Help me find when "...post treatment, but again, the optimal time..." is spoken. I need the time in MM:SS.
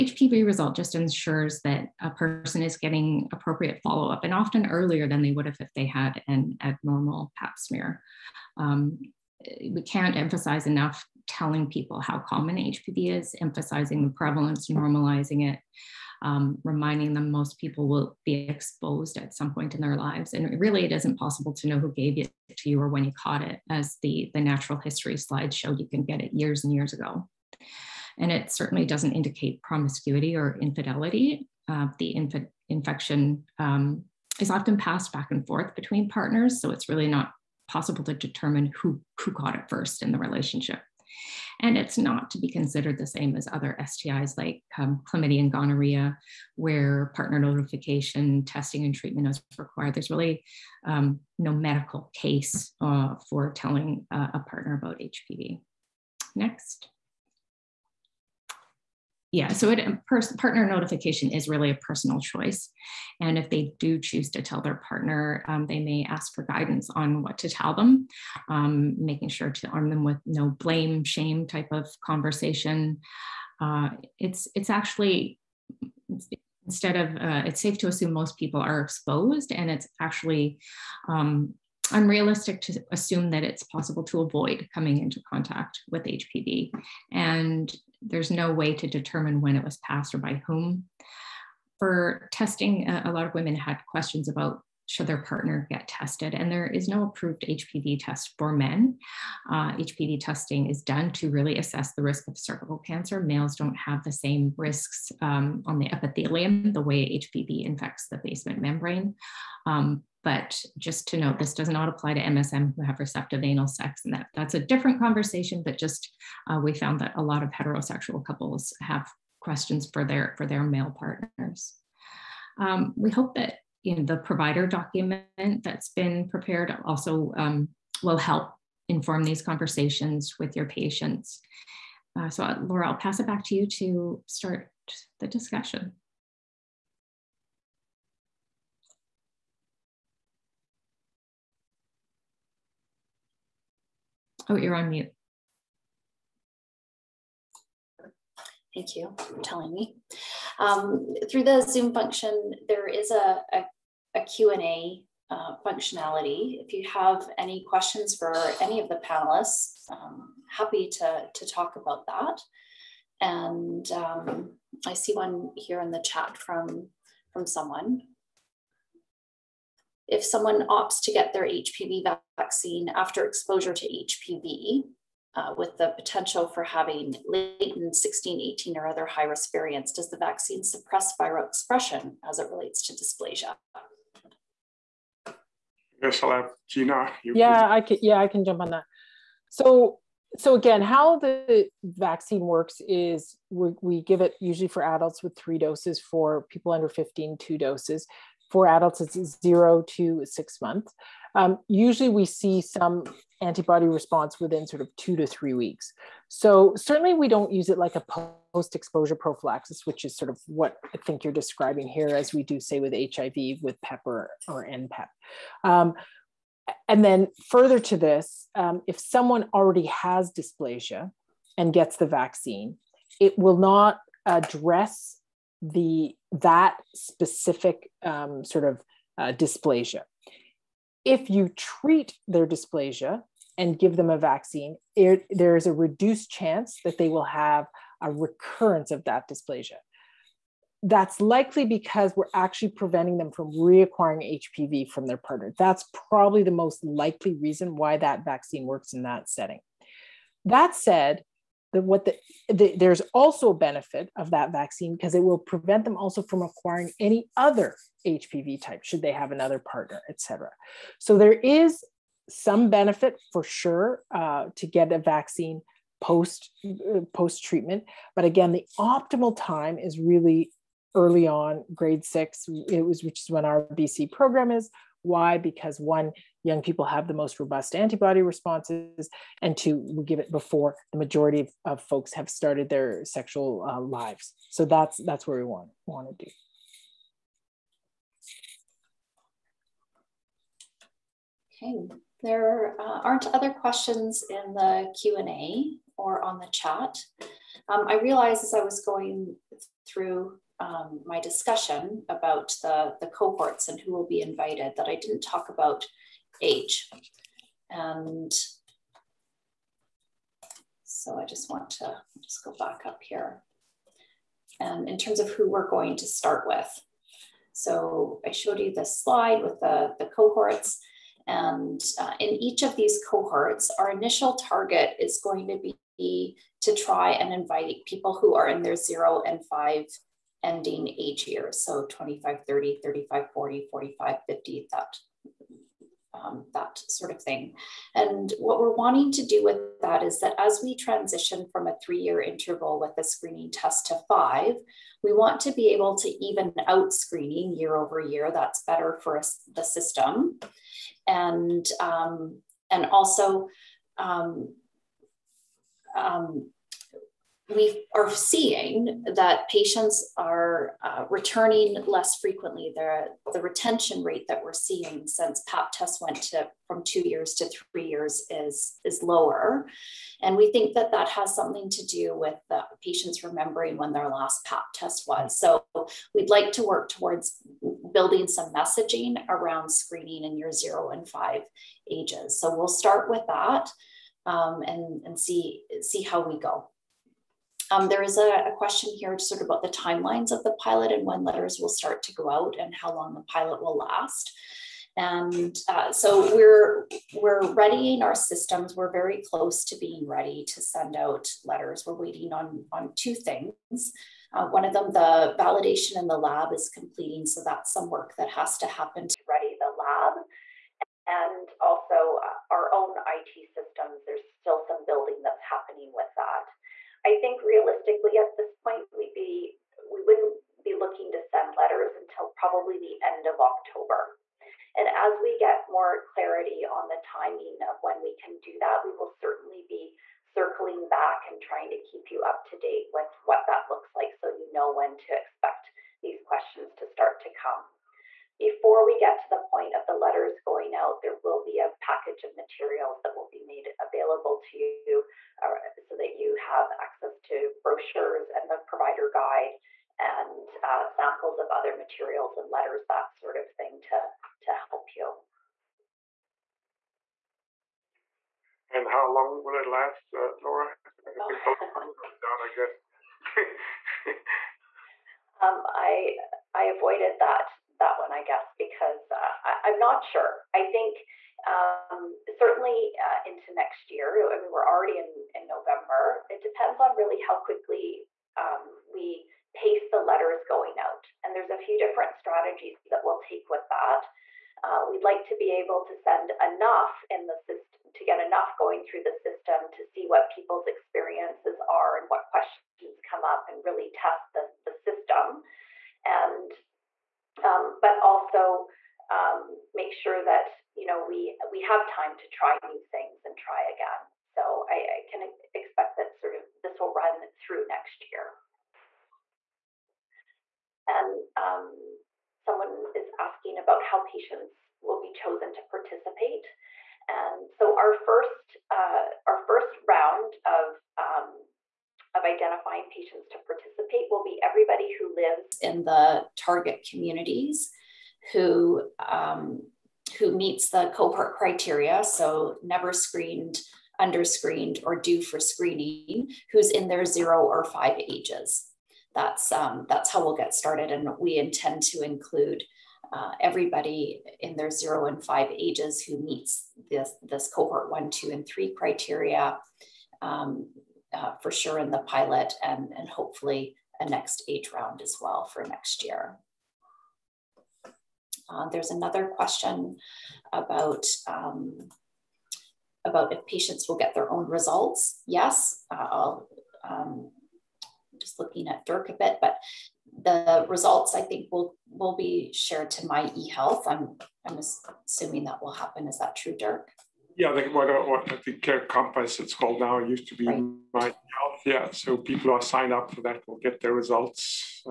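04:27.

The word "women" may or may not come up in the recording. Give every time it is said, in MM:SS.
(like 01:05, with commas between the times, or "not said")
01:33.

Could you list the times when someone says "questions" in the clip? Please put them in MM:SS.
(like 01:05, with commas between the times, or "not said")
01:33, 01:59, 02:37, 04:53, 06:28, 07:16, 08:12, 09:19.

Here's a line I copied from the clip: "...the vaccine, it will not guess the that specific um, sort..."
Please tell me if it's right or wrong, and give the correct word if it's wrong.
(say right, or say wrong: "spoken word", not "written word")
wrong: "address", not "guess".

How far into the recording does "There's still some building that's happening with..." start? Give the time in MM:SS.
06:54.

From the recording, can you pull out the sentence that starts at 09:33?
I'm I'm assuming that will happen.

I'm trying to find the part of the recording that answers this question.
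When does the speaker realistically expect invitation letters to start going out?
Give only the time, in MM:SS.
07:03.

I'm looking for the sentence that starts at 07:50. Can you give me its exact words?
I think um, certainly uh, into next year.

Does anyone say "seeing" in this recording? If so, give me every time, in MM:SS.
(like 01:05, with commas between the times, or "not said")
05:58, 06:04.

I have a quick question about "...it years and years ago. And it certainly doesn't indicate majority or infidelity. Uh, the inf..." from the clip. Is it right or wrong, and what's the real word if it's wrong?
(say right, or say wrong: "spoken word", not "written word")
wrong: "promiscuity", not "majority".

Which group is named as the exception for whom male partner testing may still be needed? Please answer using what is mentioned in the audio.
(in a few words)
MSM who have receptive anal sex.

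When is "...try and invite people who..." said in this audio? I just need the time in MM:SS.
05:26.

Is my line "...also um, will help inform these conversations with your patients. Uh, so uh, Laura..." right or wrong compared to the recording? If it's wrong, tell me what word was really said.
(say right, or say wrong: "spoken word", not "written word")
right.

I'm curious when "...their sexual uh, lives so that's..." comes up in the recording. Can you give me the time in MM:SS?
04:42.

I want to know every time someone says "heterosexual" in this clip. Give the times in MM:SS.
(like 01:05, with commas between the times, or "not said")
01:57.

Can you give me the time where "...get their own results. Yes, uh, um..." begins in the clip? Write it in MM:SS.
09:23.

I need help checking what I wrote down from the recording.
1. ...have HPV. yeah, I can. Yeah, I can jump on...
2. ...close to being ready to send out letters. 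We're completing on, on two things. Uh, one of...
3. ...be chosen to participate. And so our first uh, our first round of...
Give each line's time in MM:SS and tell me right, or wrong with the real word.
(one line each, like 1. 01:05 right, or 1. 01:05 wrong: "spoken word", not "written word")
1. 03:06 wrong: "Gina", not "HPV"
2. 06:39 wrong: "waiting", not "completing"
3. 08:35 right.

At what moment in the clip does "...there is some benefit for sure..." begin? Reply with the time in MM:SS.
04:21.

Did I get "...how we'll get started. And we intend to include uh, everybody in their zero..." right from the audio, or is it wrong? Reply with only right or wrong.
right.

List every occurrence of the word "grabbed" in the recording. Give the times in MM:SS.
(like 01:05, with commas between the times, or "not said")
not said.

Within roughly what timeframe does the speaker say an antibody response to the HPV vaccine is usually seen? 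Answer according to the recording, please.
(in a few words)
2 to 3 weeks.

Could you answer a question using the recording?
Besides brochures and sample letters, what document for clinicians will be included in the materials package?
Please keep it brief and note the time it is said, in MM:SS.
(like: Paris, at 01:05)
provider guide, at 07:28.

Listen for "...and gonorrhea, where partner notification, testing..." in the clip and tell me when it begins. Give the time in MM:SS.
00:45.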